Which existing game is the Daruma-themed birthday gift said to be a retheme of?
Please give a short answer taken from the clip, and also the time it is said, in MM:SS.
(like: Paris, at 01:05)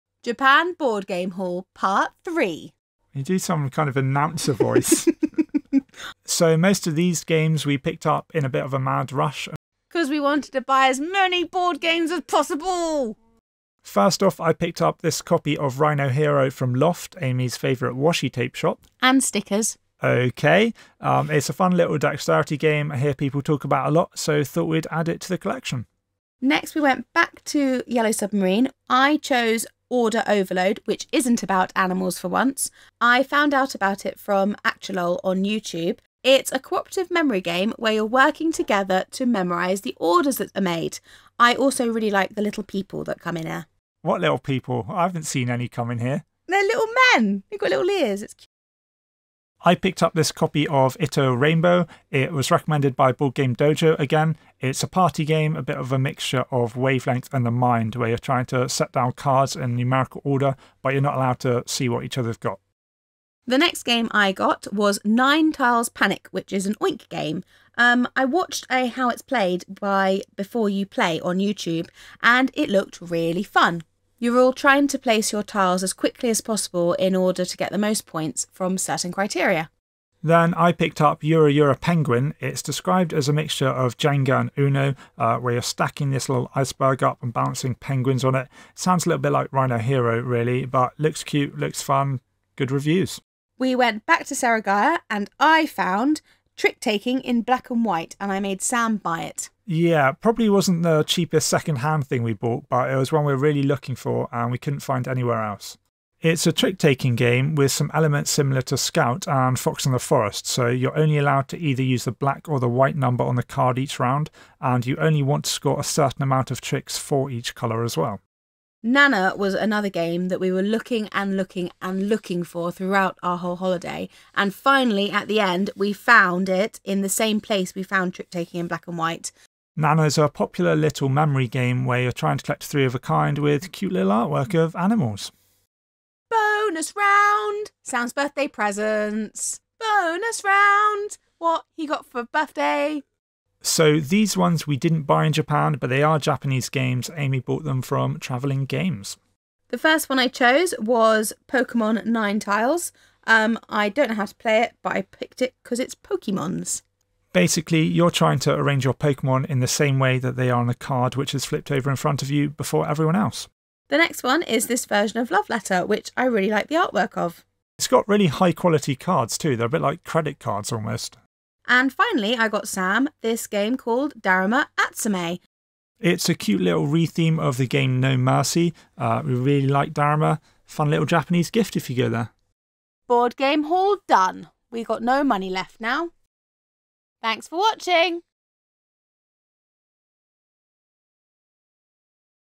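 No Mercy, at 02:57.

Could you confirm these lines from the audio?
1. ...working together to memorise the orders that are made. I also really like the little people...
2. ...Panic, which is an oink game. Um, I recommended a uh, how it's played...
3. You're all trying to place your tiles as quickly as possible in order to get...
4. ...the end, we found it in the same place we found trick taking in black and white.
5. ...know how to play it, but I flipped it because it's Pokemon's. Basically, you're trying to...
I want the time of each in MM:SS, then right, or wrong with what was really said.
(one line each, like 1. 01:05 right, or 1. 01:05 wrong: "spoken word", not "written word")
1. 00:38 right
2. 01:05 wrong: "watched", not "recommended"
3. 01:14 right
4. 02:05 right
5. 02:34 wrong: "picked", not "flipped".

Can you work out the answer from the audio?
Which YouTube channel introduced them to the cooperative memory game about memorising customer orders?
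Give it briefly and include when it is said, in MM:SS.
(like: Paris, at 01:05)
Actualol, at 00:34.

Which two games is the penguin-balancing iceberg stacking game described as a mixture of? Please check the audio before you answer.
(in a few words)
Jenga and Uno.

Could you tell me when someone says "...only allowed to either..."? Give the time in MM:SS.
01:50.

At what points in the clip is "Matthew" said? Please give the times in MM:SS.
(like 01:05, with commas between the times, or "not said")
not said.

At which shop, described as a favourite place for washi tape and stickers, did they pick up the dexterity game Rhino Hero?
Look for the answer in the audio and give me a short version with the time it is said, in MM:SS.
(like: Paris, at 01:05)
Loft, at 00:16.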